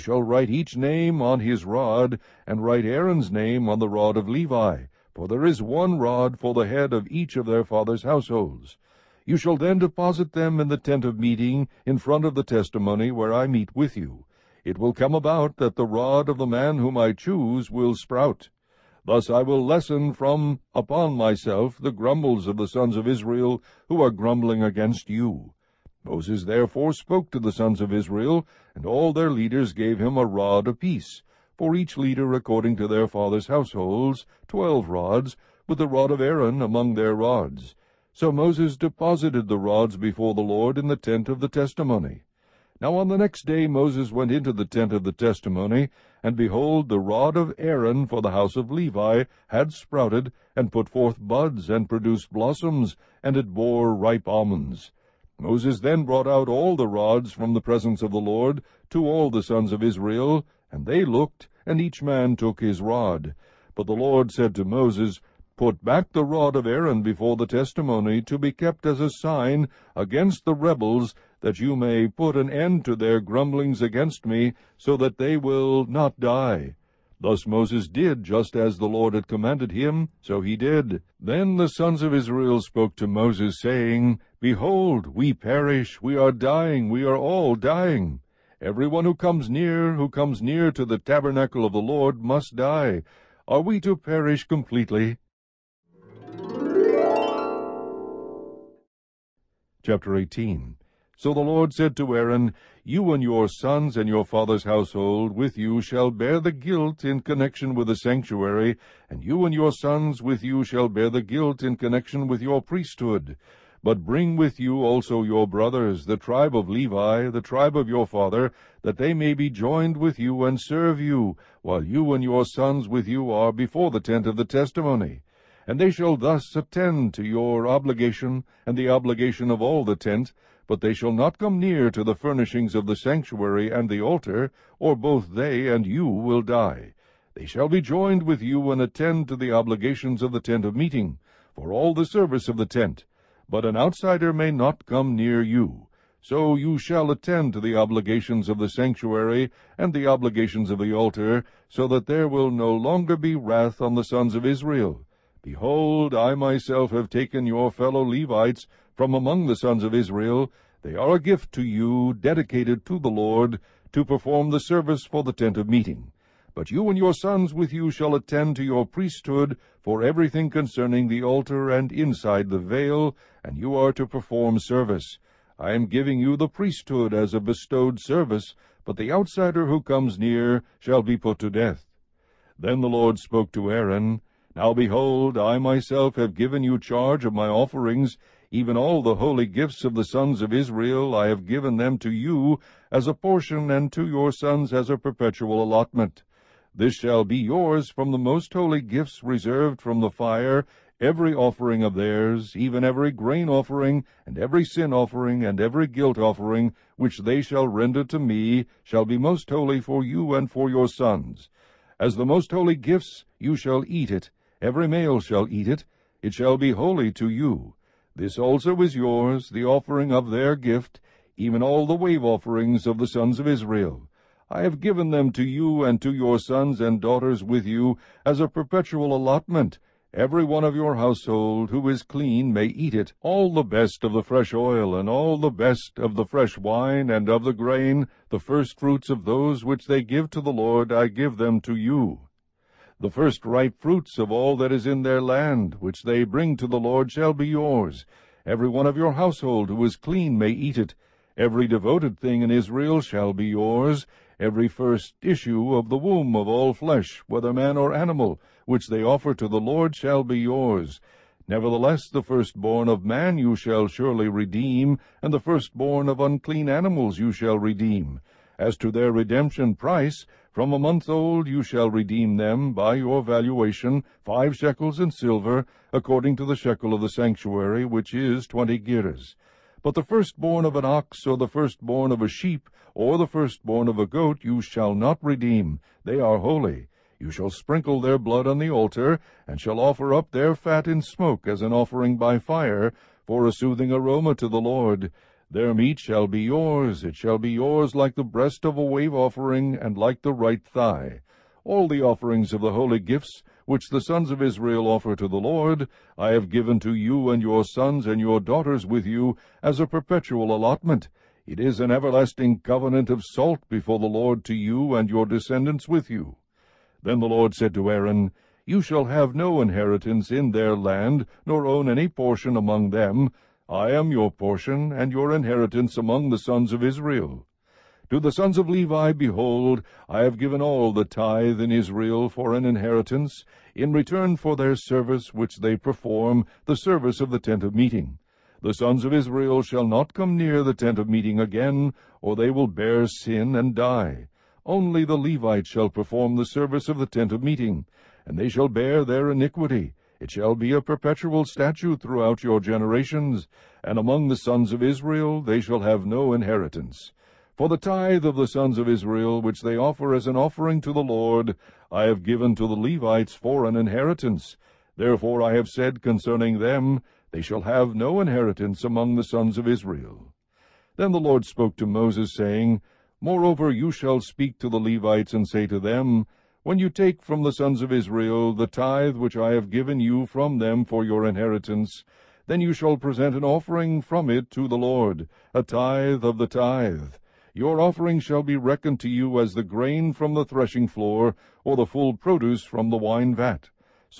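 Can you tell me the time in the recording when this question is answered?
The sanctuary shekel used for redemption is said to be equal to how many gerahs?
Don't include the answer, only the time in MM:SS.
04:38.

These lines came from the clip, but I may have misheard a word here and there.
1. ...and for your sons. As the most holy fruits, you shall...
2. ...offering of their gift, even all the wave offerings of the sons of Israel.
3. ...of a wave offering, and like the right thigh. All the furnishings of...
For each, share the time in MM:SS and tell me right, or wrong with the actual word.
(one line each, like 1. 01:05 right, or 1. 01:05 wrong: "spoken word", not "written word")
1. 03:30 wrong: "gifts", not "fruits"
2. 03:39 right
3. 04:58 wrong: "offerings", not "furnishings".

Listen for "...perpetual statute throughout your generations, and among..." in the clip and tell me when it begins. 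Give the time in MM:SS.
05:50.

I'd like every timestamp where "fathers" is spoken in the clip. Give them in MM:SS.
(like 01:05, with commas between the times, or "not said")
00:07, 00:33, 01:44, 01:58.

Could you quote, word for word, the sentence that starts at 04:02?
The first ripe fruits of all that is in their land, which they bring to the Lord, shall be yours.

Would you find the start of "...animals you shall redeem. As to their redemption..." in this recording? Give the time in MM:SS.
04:26.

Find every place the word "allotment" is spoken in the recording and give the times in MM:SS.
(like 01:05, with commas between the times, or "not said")
03:15, 03:49, 05:10.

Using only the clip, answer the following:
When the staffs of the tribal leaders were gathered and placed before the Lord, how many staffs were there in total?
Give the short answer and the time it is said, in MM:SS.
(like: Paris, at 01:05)
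12, at 00:34.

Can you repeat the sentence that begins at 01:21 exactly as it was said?
Then the sons of Israel spoke to Moses, saying, Behold, we perish, we are dying, we are all dying.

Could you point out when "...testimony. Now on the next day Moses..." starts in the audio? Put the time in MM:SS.
00:41.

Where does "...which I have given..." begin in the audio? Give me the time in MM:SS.
06:19.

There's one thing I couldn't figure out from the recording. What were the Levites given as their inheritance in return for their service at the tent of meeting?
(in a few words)
All the tithe.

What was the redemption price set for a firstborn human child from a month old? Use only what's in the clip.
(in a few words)
5 shekels in silver.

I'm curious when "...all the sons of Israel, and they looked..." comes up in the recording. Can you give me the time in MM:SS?
00:59.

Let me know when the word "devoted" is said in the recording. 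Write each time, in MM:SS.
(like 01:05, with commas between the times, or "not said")
04:11.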